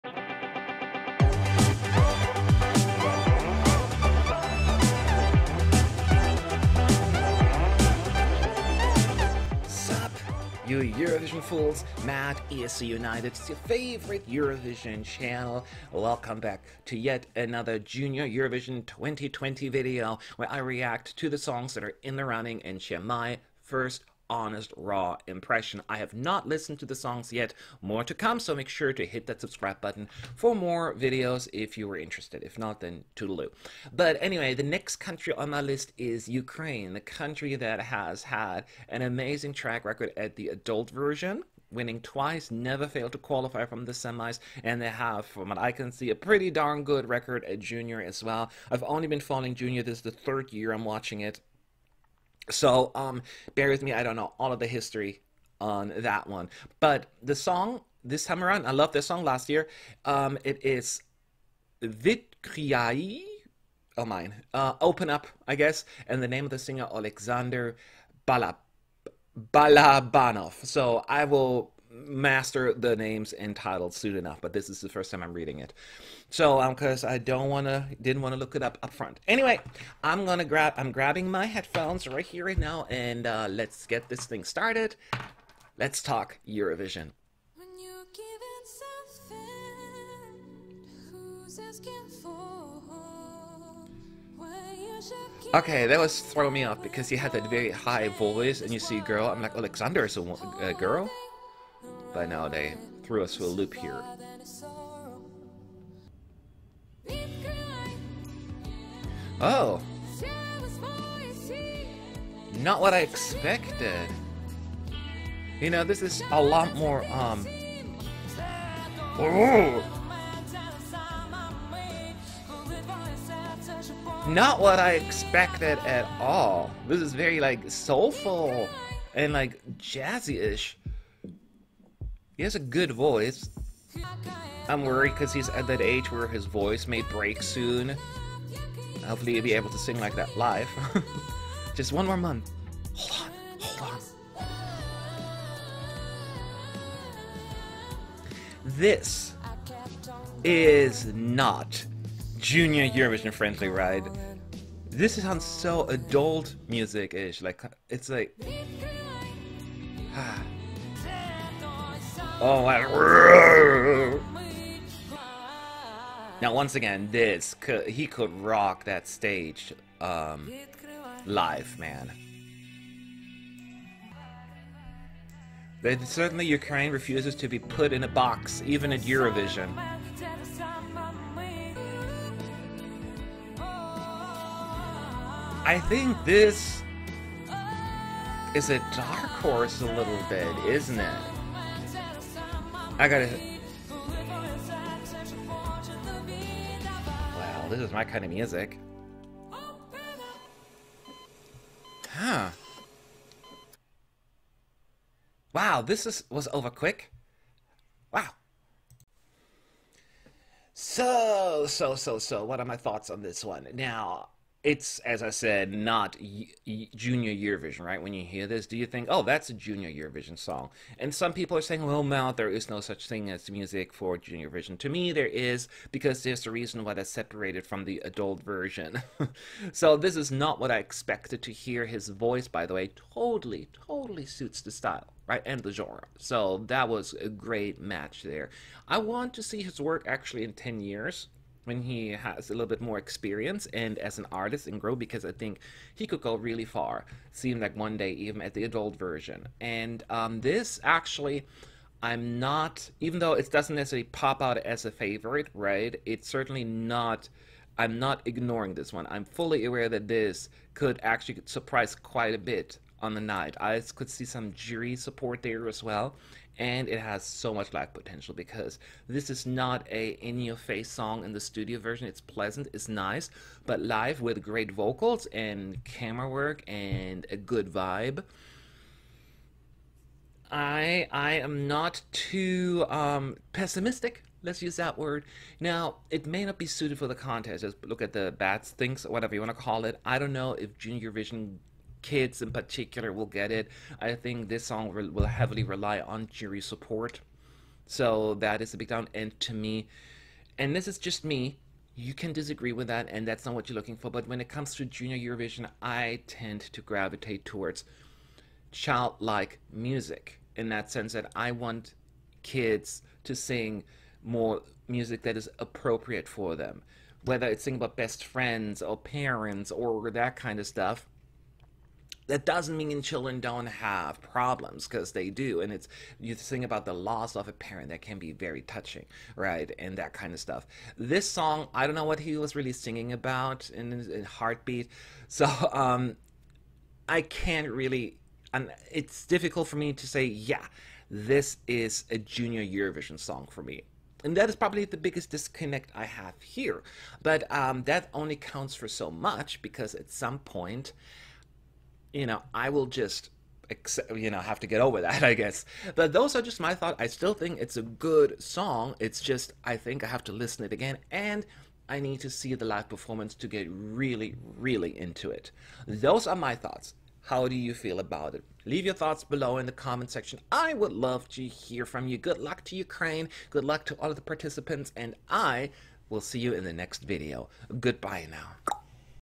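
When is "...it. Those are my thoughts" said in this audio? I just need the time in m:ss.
6:05.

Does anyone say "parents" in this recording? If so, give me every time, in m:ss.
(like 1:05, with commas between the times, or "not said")
5:18, 5:27.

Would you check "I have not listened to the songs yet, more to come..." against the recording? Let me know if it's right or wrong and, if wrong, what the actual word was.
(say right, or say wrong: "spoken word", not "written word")
right.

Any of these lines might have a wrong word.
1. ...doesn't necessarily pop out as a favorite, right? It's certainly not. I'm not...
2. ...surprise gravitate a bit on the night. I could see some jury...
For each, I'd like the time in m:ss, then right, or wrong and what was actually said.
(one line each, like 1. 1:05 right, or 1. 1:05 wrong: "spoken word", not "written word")
1. 4:13 right
2. 4:21 wrong: "quite", not "gravitate".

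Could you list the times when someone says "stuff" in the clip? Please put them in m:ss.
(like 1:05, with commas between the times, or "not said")
5:20, 5:30.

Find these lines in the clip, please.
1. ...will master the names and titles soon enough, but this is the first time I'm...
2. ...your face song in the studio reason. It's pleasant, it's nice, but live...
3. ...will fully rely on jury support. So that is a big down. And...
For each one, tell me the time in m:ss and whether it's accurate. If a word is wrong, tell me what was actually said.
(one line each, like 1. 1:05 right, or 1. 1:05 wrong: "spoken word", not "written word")
1. 1:11 right
2. 4:30 wrong: "version", not "reason"
3. 4:55 wrong: "heavily", not "fully".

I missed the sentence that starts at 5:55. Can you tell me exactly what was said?
But those are just my thoughts.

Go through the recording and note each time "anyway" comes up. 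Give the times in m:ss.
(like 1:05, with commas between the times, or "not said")
0:34, 1:19.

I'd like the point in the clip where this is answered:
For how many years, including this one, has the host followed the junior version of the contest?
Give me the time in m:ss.
0:50.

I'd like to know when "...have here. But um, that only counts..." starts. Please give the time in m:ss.
5:46.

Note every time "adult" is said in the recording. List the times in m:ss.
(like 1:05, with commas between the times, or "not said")
0:40, 2:35, 3:48, 4:08.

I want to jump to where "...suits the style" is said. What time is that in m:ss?
3:54.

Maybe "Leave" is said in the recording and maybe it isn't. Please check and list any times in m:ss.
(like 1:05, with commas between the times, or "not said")
6:08.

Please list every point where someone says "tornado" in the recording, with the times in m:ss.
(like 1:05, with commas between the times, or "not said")
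not said.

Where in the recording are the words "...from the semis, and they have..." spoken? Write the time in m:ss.
0:43.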